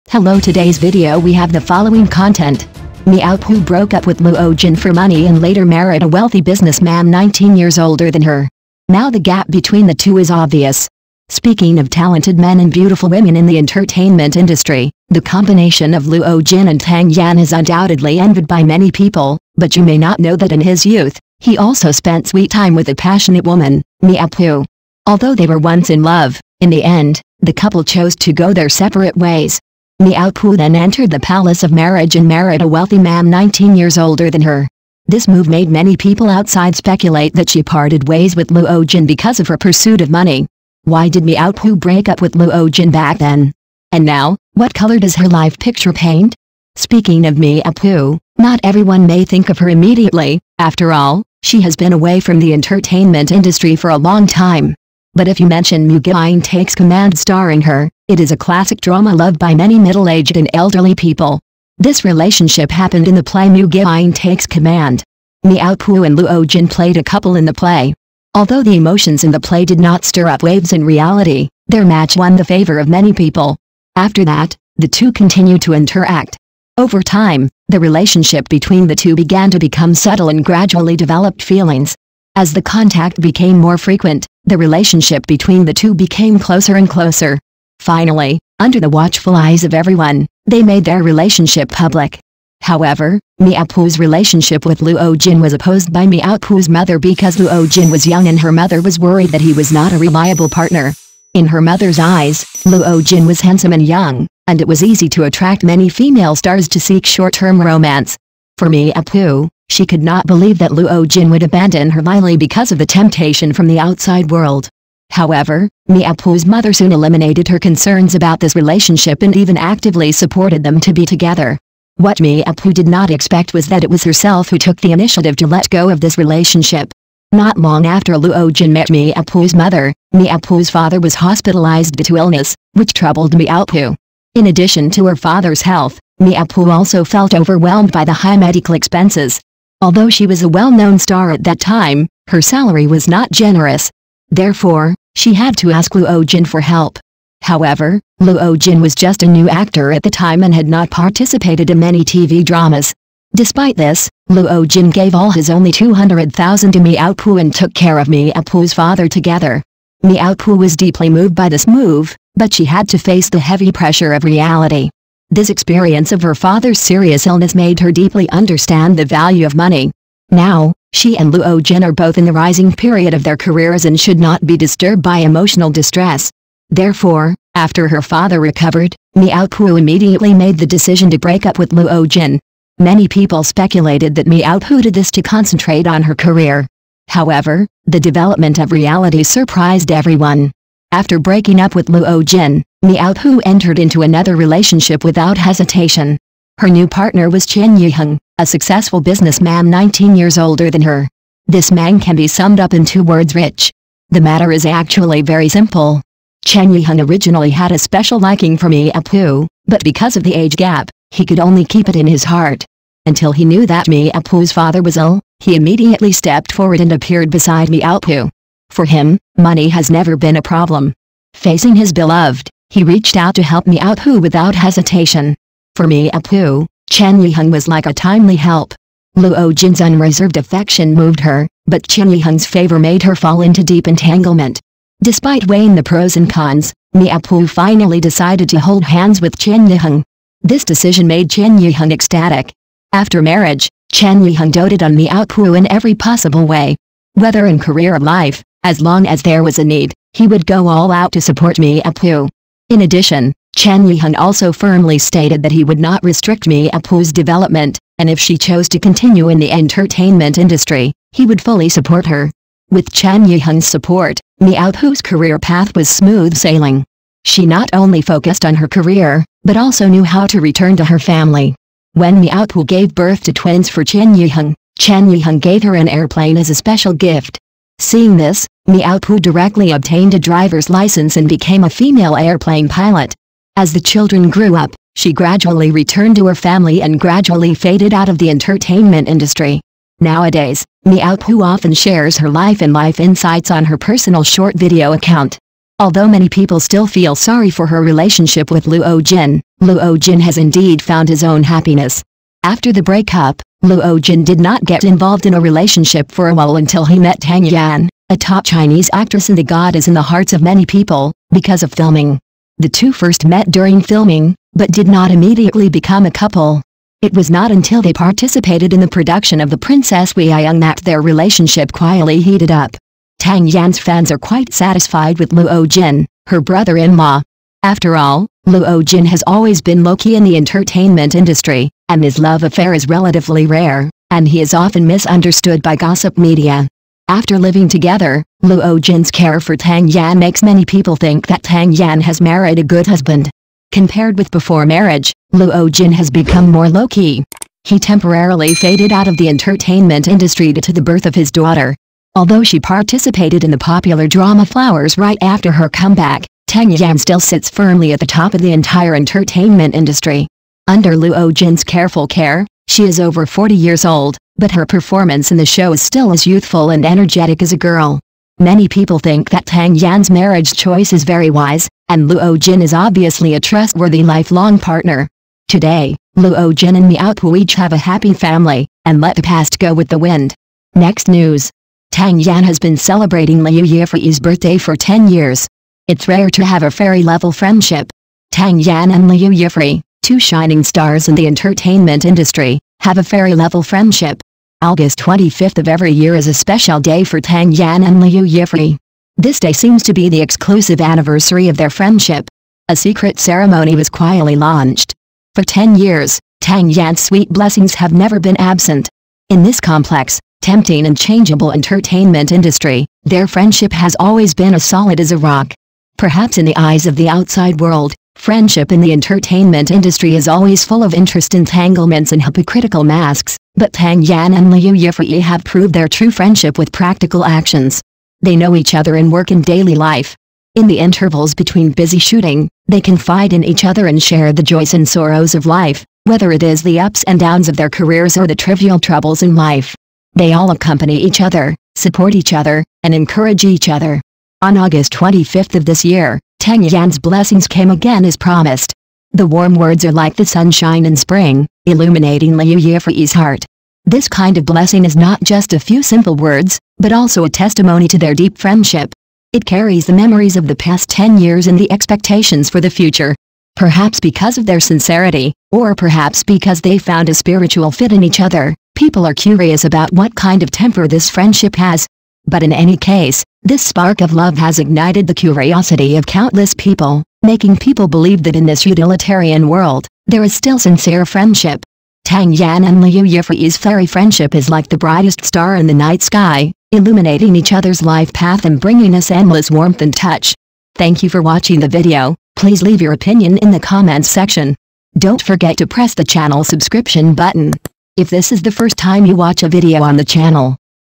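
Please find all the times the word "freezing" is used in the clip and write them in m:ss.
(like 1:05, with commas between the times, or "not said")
not said.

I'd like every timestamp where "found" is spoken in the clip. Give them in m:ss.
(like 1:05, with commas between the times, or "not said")
5:00, 7:46.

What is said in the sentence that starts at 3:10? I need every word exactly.
After breaking up with Luo Jin, Miao Pu entered into another relationship without hesitation.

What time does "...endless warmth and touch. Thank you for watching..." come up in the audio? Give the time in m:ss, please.
8:09.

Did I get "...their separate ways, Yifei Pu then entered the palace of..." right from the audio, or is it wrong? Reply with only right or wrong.
wrong.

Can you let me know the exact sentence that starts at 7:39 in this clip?
It carries the memories of the past 10 years and the expectations for the future.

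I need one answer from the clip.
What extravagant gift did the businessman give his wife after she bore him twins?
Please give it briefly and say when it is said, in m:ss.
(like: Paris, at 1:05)
An airplane, at 4:35.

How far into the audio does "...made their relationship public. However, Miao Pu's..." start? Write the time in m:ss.
1:30.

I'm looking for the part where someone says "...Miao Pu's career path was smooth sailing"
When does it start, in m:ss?
4:24.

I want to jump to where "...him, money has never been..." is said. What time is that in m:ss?
3:38.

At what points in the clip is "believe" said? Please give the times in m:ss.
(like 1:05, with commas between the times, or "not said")
1:50, 7:57.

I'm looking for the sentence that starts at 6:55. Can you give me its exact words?
Perhaps in the eyes of the outside world, friendship in the entertainment industry is always full of interest entanglements and hypocritical masks.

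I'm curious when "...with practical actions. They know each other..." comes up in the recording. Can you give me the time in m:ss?
7:06.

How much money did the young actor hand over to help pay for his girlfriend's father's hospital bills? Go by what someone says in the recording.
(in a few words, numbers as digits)
200,000.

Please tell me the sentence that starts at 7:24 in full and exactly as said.
On August 25th of this year, Tang Yan's blessings came again as promised.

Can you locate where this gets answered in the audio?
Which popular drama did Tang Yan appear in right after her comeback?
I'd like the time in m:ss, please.
5:54.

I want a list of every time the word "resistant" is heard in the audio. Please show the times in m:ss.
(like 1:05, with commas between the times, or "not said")
not said.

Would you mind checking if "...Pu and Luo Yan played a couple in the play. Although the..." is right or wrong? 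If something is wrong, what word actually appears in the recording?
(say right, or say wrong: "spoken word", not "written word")
wrong: "Jin", not "Yan".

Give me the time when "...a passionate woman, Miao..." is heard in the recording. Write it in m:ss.
0:22.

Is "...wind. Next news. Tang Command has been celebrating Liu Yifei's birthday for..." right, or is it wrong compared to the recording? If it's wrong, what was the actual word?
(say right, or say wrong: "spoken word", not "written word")
wrong: "Yan", not "Command".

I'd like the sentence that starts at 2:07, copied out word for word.
Not long after Luo Jin met Pu's mother, Pu's father was hospitalized due to illness, which troubled Pu.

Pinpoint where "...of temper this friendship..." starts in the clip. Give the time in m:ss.
7:50.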